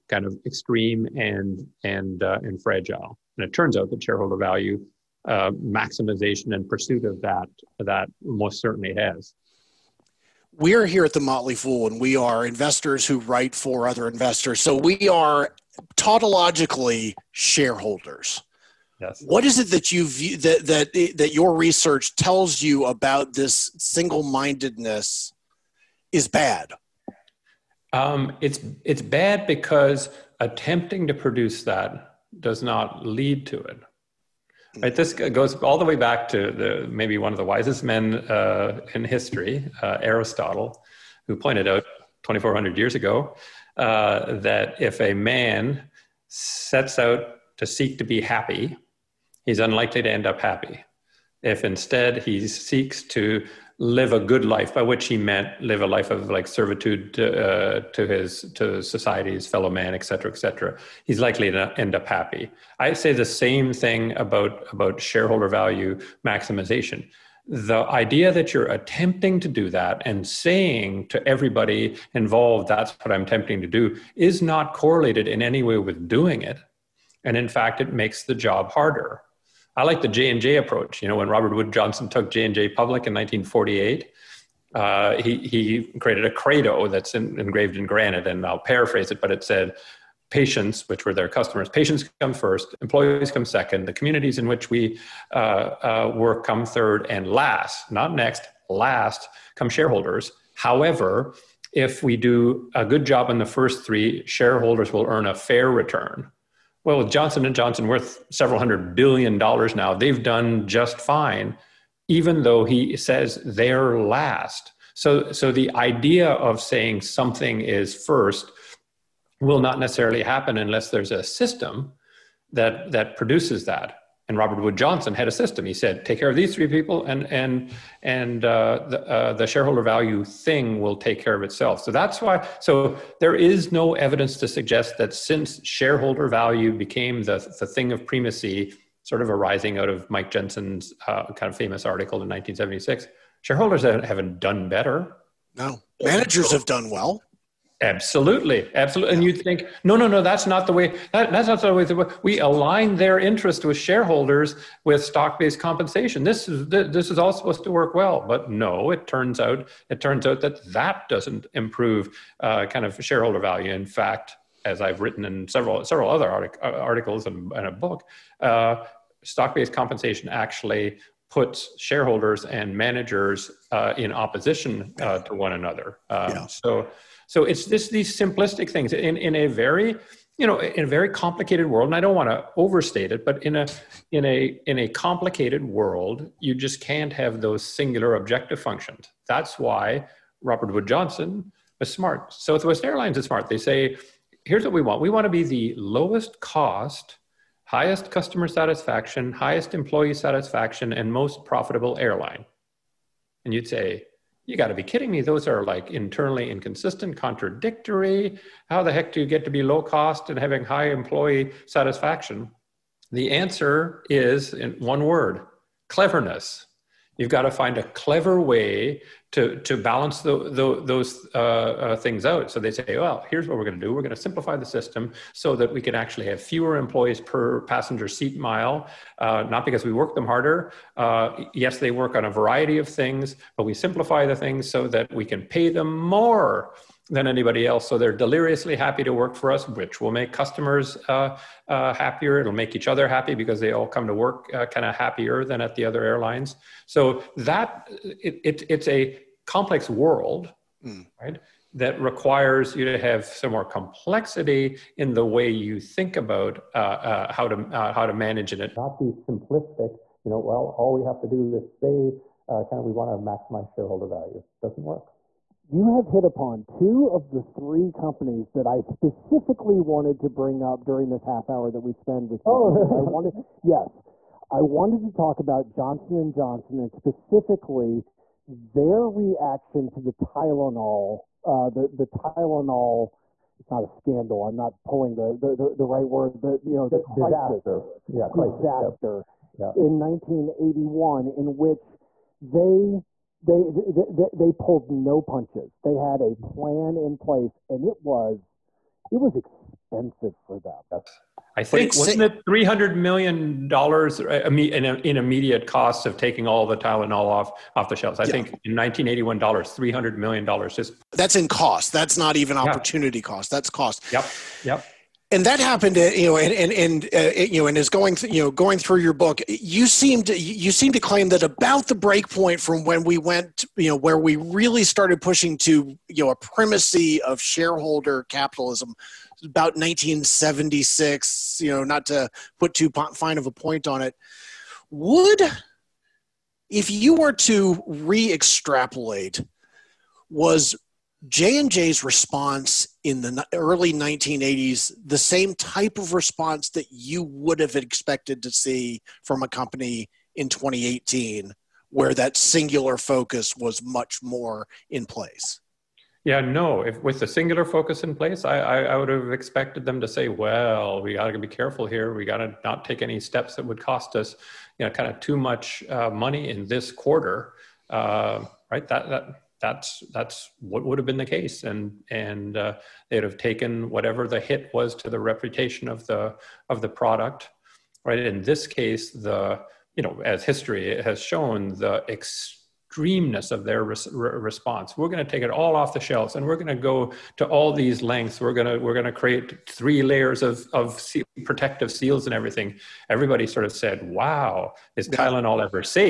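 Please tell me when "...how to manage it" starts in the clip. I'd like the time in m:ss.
4:17.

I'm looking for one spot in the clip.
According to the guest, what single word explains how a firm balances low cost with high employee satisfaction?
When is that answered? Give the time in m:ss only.
3:35.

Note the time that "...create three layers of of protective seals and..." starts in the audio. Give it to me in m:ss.
6:29.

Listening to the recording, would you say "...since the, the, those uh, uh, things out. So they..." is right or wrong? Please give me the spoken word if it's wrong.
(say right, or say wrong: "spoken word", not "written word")
wrong: "balance", not "since".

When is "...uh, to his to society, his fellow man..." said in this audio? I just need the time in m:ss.
0:57.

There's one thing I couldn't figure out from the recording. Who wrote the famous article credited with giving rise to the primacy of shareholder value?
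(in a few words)
Mike Jensen.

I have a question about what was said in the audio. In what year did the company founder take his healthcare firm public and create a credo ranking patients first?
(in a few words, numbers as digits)
1948.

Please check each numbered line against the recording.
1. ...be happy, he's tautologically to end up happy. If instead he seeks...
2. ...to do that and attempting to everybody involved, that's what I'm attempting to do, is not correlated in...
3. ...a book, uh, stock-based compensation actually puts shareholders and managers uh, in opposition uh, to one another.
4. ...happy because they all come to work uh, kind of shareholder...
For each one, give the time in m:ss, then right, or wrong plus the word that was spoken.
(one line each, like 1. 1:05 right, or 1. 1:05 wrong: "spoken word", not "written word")
1. 0:48 wrong: "unlikely", not "tautologically"
2. 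1:09 wrong: "saying", not "attempting"
3. 2:47 right
4. 4:03 wrong: "happier", not "shareholder".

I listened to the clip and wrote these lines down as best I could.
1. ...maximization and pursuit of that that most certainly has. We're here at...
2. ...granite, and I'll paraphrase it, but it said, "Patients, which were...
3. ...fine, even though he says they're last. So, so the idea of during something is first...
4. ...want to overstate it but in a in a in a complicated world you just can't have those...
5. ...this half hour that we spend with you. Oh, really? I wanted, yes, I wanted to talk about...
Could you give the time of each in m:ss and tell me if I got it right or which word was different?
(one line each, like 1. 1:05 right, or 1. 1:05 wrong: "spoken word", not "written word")
1. 0:05 right
2. 1:27 right
3. 1:50 wrong: "saying", not "during"
4. 3:02 right
5. 4:31 right.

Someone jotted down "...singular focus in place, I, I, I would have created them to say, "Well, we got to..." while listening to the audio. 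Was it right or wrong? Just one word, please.
wrong.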